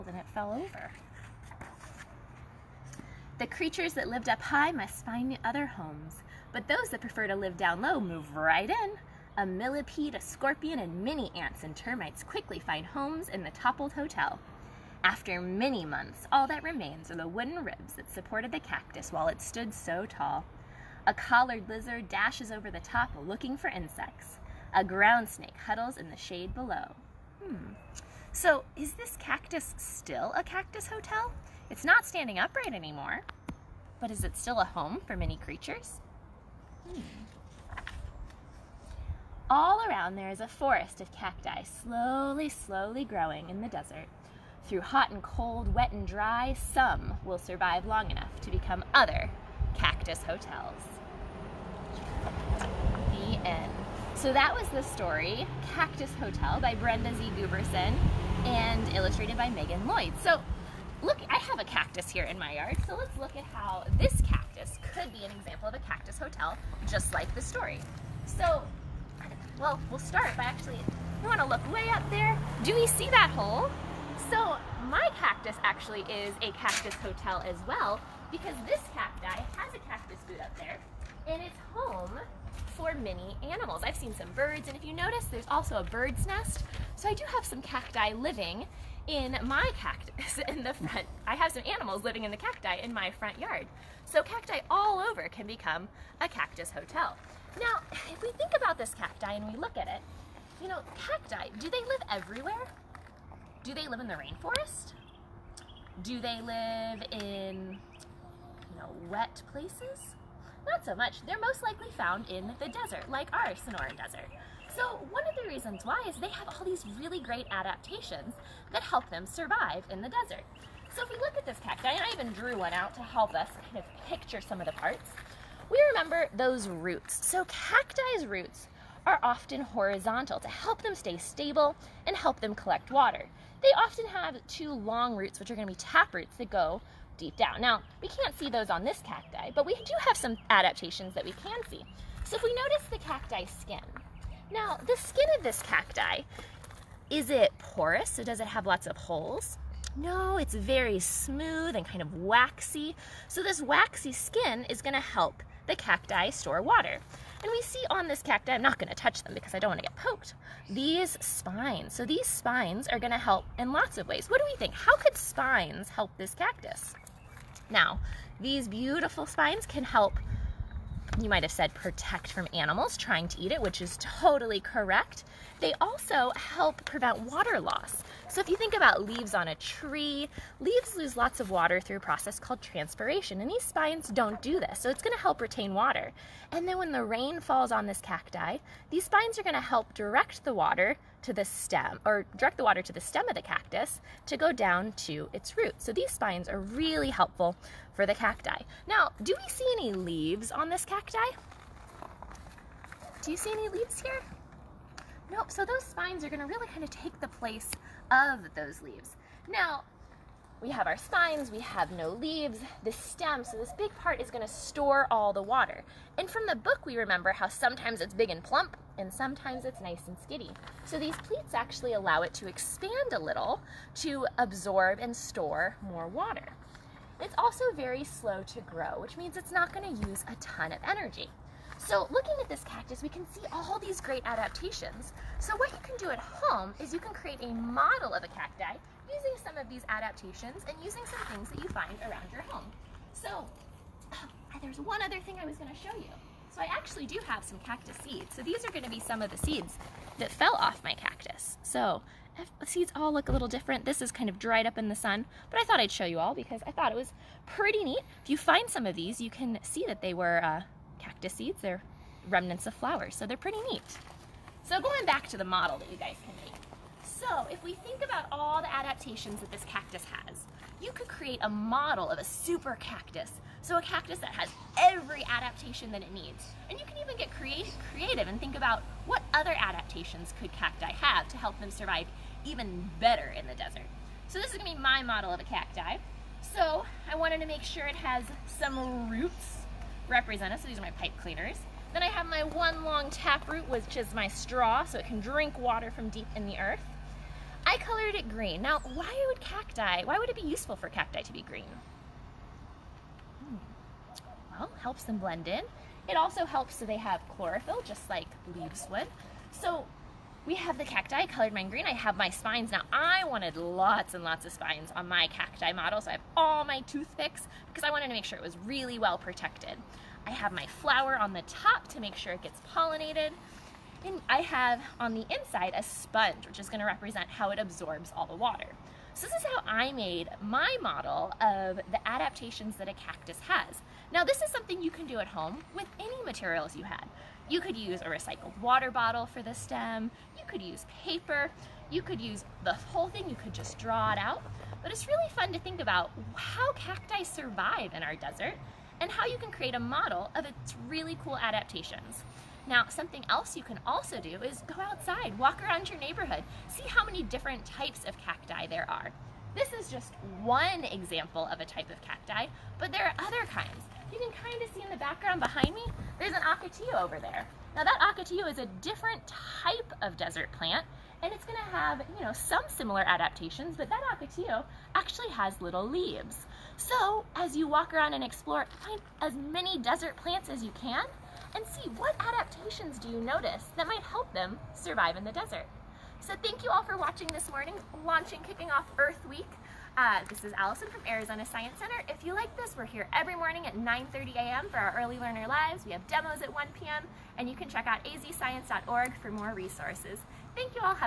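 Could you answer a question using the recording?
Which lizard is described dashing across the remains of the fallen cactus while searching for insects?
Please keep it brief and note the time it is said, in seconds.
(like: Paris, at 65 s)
Collared lizard, at 21 s.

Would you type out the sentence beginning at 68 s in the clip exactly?
So, well, we'll start by actually, we wanna look way up there.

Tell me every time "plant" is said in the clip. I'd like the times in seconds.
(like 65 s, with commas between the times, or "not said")
370 s, 380 s.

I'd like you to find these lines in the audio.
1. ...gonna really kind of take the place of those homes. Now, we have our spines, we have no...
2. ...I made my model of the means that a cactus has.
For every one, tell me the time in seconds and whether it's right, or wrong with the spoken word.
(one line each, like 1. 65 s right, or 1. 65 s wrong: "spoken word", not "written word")
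1. 206 s wrong: "leaves", not "homes"
2. 329 s wrong: "adaptations", not "means".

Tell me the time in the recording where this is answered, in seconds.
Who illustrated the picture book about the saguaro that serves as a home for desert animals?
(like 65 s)
59 s.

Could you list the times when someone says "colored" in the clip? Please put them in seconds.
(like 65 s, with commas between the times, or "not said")
297 s, 311 s.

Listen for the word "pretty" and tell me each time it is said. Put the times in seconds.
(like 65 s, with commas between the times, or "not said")
257 s, 263 s.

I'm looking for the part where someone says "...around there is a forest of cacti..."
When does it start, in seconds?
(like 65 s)
39 s.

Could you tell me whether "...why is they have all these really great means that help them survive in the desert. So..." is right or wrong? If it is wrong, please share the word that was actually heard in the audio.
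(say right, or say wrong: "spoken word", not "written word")
wrong: "adaptations", not "means".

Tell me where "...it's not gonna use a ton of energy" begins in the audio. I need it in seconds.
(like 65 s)
229 s.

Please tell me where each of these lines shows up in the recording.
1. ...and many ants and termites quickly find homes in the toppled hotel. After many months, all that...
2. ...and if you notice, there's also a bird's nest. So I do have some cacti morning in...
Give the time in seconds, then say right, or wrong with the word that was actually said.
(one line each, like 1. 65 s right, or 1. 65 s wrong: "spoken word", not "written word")
1. 10 s right
2. 84 s wrong: "living", not "morning".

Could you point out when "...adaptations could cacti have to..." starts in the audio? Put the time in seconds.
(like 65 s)
279 s.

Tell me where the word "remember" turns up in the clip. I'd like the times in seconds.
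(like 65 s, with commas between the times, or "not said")
125 s, 216 s.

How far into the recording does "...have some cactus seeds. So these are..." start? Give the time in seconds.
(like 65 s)
247 s.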